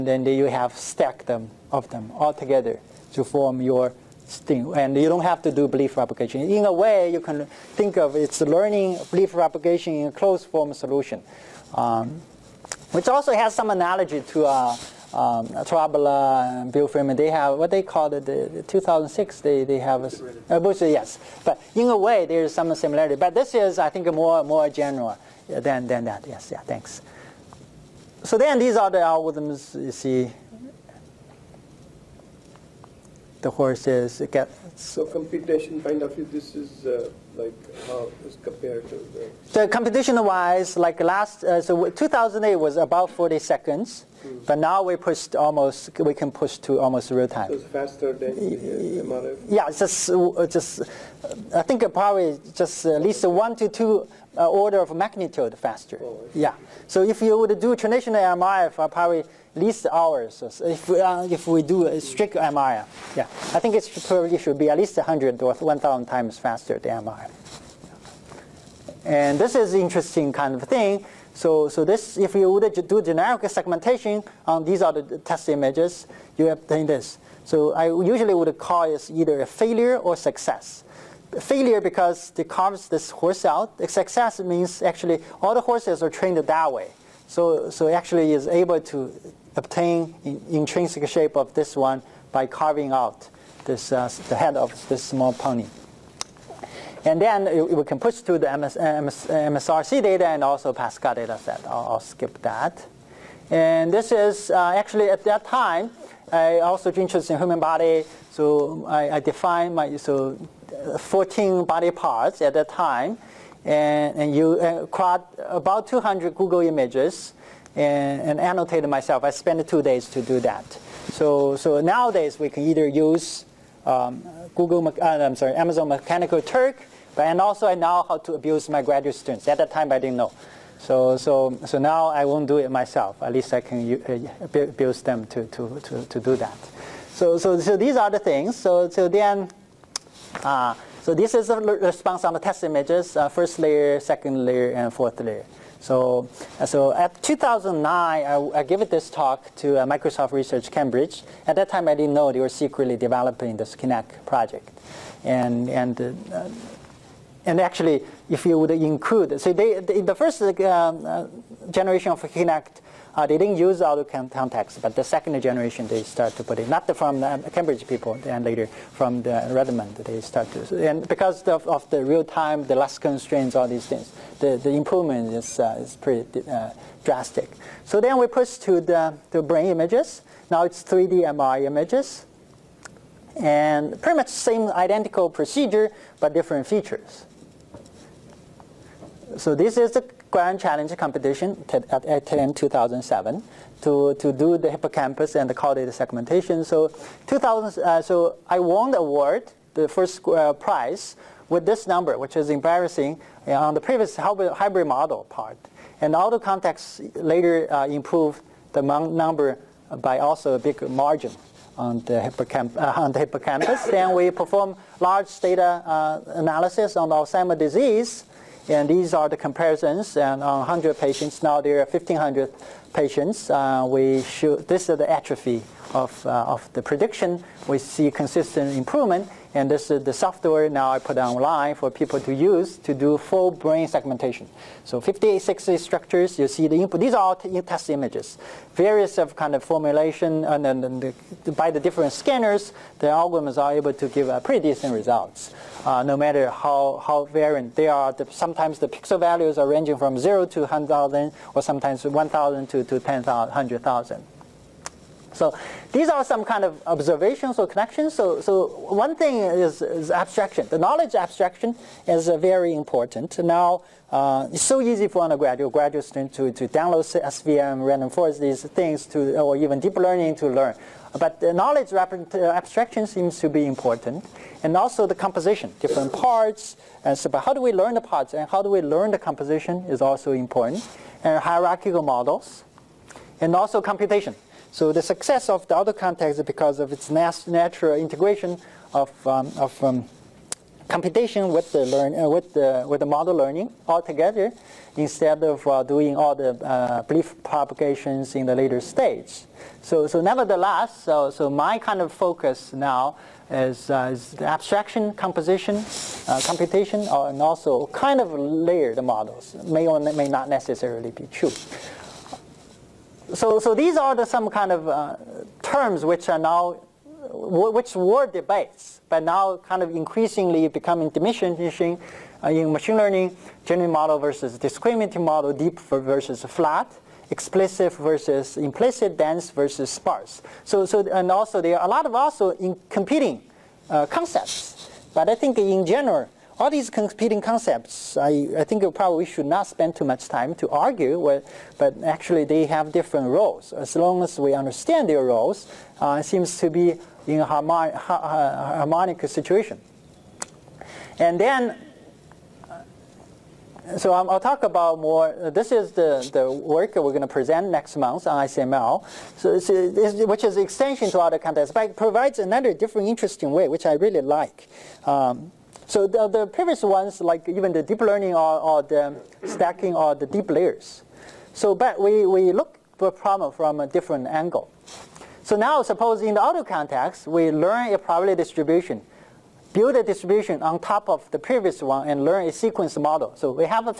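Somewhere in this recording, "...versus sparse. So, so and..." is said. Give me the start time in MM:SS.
05:29.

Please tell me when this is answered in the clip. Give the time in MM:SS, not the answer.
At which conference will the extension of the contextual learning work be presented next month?
05:58.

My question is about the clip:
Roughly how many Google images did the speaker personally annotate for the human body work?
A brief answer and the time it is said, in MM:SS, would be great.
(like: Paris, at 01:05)
200, at 01:55.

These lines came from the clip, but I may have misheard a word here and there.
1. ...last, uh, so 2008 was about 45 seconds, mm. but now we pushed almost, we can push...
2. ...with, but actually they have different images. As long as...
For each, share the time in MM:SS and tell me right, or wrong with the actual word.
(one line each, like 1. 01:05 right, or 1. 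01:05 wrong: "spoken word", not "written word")
1. 00:41 wrong: "40", not "45"
2. 05:41 wrong: "roles", not "images".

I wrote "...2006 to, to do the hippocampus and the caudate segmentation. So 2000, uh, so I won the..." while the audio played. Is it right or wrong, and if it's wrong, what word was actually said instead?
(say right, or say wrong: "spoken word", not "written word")
wrong: "2007", not "2006".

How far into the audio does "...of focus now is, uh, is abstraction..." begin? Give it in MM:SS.
05:02.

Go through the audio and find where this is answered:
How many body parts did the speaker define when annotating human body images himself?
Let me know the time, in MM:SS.
01:50.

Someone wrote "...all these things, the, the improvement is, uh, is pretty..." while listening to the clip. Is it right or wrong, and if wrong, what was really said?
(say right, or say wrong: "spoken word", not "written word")
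right.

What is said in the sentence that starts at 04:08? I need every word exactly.
The, sometimes the pixel values are ranging from 0 to 100,000, or sometimes 1,000 to, to 10,000, 100,000.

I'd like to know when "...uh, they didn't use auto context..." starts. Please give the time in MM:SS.
02:43.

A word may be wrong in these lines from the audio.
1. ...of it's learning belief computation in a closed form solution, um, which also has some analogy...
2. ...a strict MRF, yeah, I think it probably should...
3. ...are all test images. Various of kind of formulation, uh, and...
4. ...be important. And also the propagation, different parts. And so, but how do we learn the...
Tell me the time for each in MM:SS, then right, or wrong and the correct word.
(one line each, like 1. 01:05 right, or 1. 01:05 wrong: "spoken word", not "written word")
1. 00:07 wrong: "propagation", not "computation"
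2. 01:01 right
3. 03:57 right
4. 04:33 wrong: "composition", not "propagation".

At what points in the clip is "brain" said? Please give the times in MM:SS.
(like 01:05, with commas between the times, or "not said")
02:59, 03:53.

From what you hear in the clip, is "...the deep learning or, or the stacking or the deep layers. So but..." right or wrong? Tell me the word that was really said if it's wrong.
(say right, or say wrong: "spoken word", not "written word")
right.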